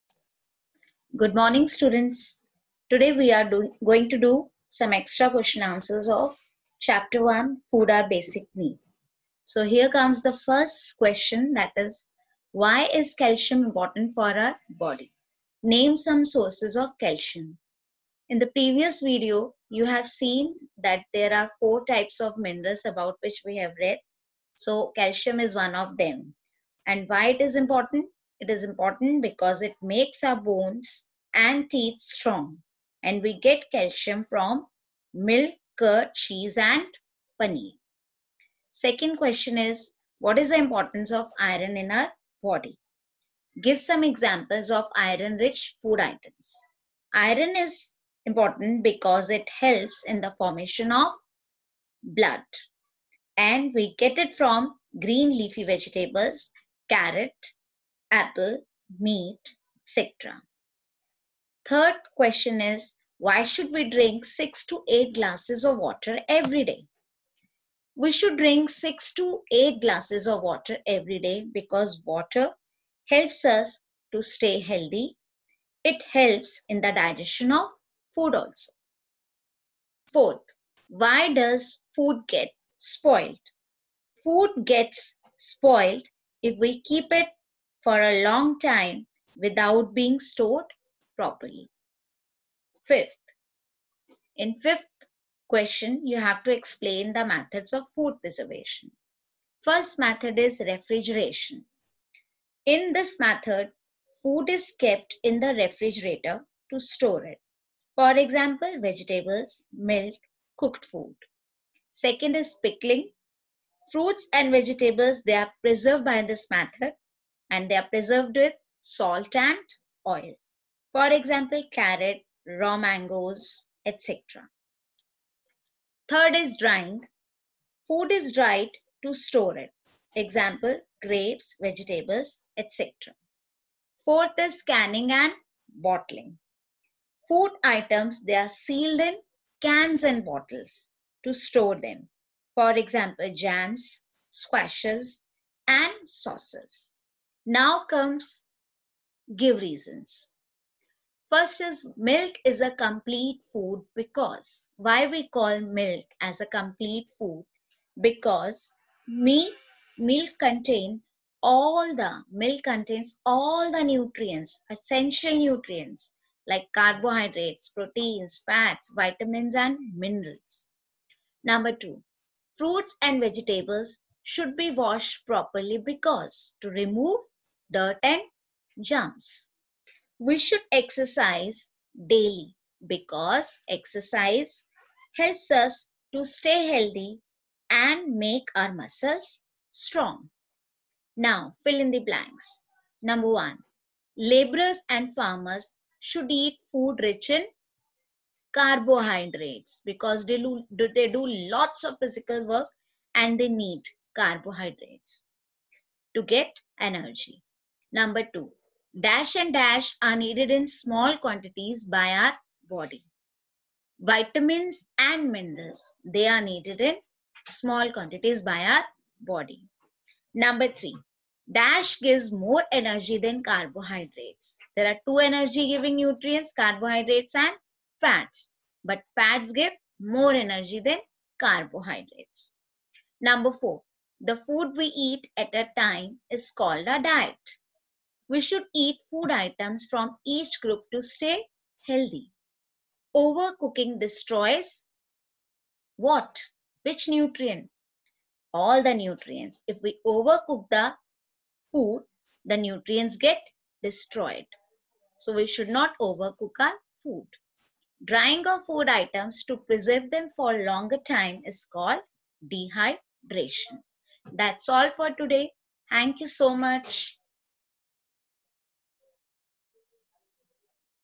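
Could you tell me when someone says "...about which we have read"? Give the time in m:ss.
0:22.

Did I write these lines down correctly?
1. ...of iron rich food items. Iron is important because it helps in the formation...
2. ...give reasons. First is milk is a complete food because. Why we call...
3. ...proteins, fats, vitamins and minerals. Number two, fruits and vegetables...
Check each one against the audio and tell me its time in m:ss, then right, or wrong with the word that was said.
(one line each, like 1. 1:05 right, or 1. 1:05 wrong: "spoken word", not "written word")
1. 0:44 right
2. 2:29 right
3. 2:47 right.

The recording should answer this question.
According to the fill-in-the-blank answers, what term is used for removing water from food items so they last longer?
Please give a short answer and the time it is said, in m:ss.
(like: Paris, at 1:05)
Dehydration, at 4:22.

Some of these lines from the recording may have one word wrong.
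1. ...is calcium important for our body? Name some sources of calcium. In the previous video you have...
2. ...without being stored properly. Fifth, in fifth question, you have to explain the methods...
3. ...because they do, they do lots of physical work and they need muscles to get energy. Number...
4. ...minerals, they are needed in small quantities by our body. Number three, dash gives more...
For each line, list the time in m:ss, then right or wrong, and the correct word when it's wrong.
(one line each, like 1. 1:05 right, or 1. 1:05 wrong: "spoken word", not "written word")
1. 0:12 right
2. 1:29 right
3. 3:19 wrong: "carbohydrates", not "muscles"
4. 3:35 right.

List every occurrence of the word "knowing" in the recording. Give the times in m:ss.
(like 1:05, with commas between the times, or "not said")
not said.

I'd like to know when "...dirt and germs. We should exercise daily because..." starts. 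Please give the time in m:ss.
2:57.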